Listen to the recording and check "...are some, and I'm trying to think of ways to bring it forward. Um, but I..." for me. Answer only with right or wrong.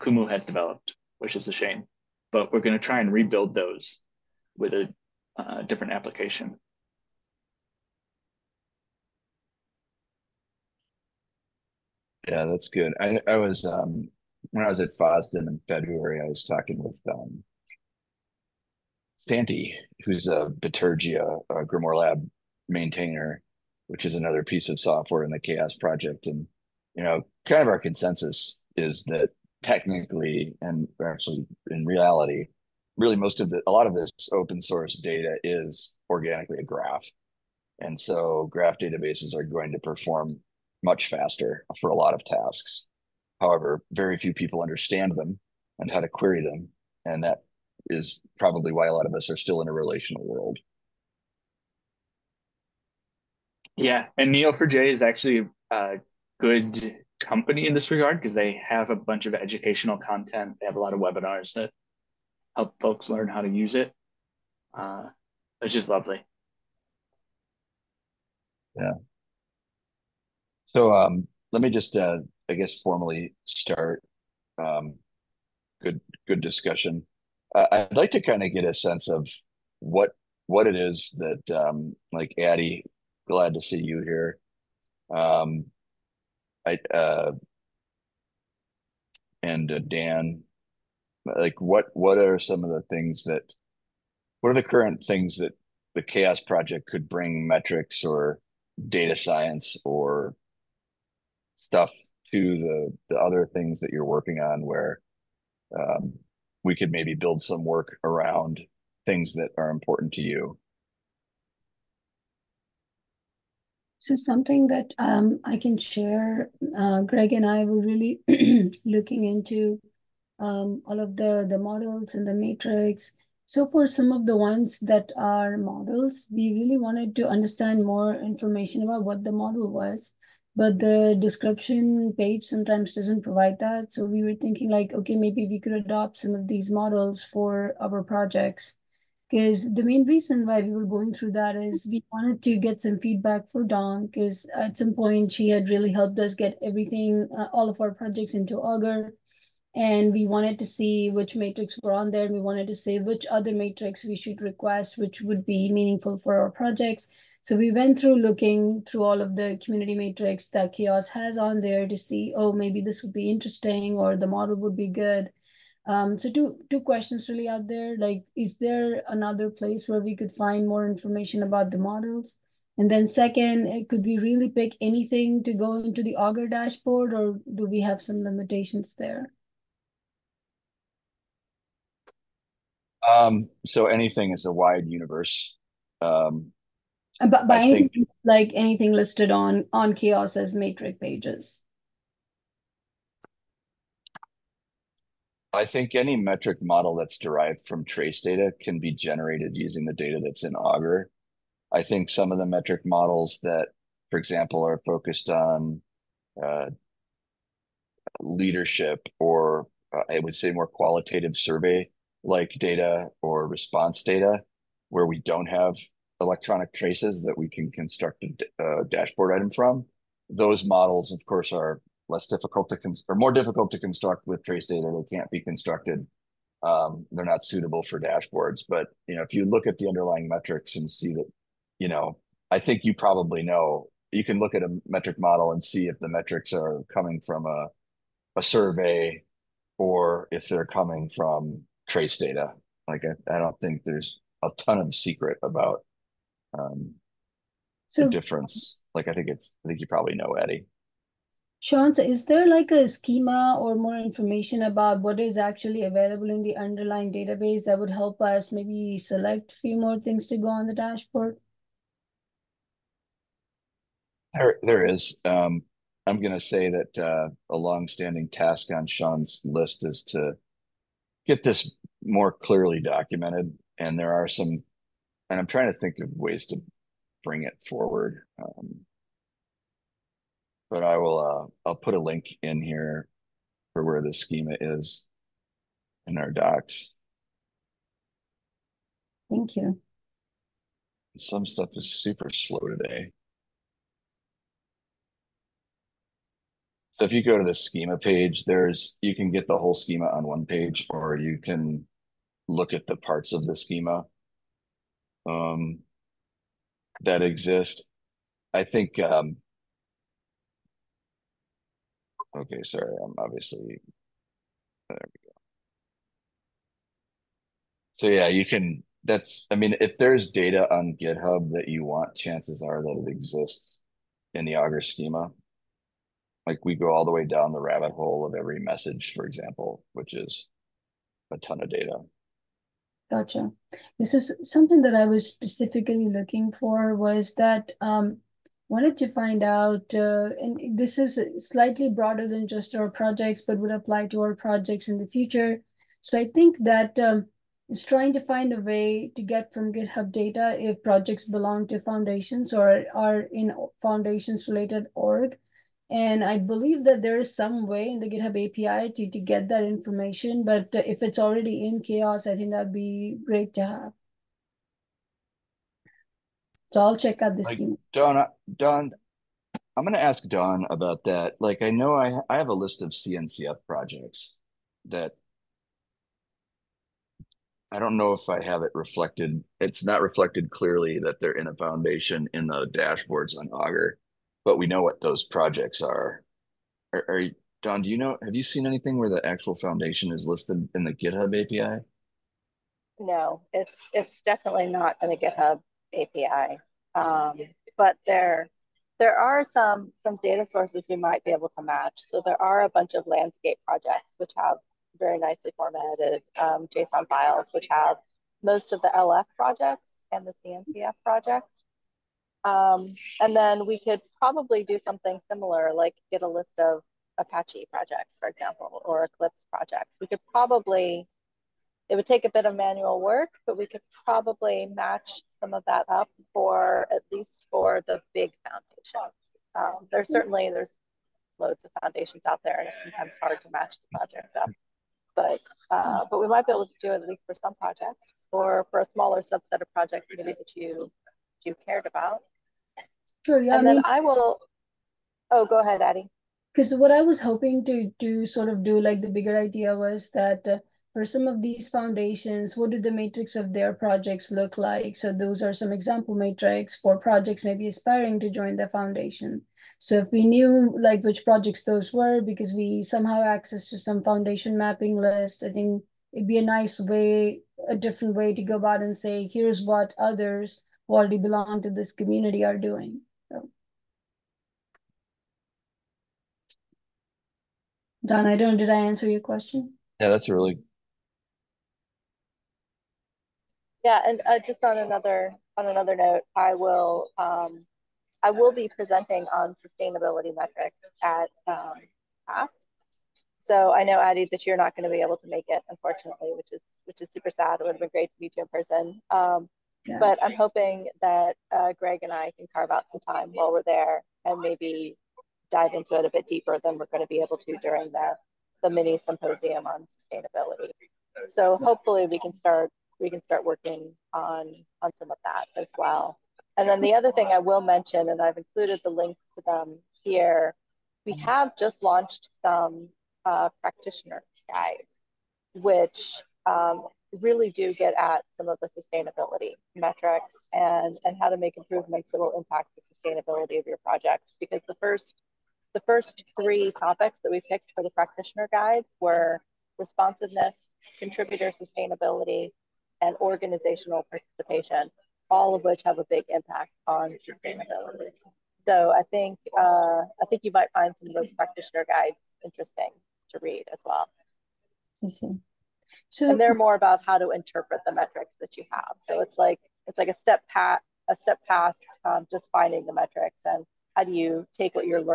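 right.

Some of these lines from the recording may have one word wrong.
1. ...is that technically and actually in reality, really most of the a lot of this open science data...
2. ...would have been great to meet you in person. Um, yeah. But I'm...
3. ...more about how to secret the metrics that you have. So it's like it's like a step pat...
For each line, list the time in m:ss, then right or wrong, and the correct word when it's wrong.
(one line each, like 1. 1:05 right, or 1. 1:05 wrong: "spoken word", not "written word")
1. 0:28 wrong: "source", not "science"
2. 8:17 right
3. 9:16 wrong: "interpret", not "secret".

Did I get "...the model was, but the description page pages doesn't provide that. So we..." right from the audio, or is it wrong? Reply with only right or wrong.
wrong.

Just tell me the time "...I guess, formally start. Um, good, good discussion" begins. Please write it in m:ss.
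1:12.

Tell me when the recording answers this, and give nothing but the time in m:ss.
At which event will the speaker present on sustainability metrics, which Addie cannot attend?
8:12.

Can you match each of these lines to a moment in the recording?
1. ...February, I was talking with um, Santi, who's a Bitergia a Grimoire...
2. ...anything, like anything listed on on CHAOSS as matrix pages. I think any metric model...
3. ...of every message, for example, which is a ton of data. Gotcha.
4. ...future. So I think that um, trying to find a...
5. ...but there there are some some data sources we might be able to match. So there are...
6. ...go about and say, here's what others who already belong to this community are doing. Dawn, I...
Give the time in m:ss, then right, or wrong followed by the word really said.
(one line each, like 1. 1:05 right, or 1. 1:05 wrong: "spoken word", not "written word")
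1. 0:15 right
2. 3:07 right
3. 5:28 right
4. 5:45 right
5. 6:37 right
6. 7:48 right.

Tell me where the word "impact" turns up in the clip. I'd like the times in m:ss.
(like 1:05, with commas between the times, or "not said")
8:52, 9:06.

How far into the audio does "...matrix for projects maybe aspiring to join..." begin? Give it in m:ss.
7:36.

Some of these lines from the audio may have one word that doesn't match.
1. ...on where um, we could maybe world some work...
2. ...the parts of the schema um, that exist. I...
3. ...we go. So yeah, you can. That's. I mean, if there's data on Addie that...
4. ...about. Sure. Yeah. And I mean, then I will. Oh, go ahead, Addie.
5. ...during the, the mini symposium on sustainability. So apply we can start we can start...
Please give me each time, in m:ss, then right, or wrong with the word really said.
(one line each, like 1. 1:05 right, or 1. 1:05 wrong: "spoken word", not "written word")
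1. 1:44 wrong: "build", not "world"
2. 5:02 right
3. 5:15 wrong: "GitHub", not "Addie"
4. 7:21 right
5. 8:27 wrong: "hopefully", not "apply".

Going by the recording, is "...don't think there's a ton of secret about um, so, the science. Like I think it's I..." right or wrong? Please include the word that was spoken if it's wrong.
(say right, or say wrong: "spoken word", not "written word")
wrong: "difference", not "science".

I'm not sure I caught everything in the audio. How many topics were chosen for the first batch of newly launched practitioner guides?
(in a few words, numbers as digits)
3.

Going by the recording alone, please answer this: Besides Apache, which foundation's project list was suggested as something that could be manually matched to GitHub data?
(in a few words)
Eclipse.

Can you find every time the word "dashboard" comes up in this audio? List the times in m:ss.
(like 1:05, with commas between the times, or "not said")
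2:56, 3:38, 3:47, 4:20, 6:22.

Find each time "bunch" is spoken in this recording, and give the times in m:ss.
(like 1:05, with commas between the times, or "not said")
0:58, 6:42.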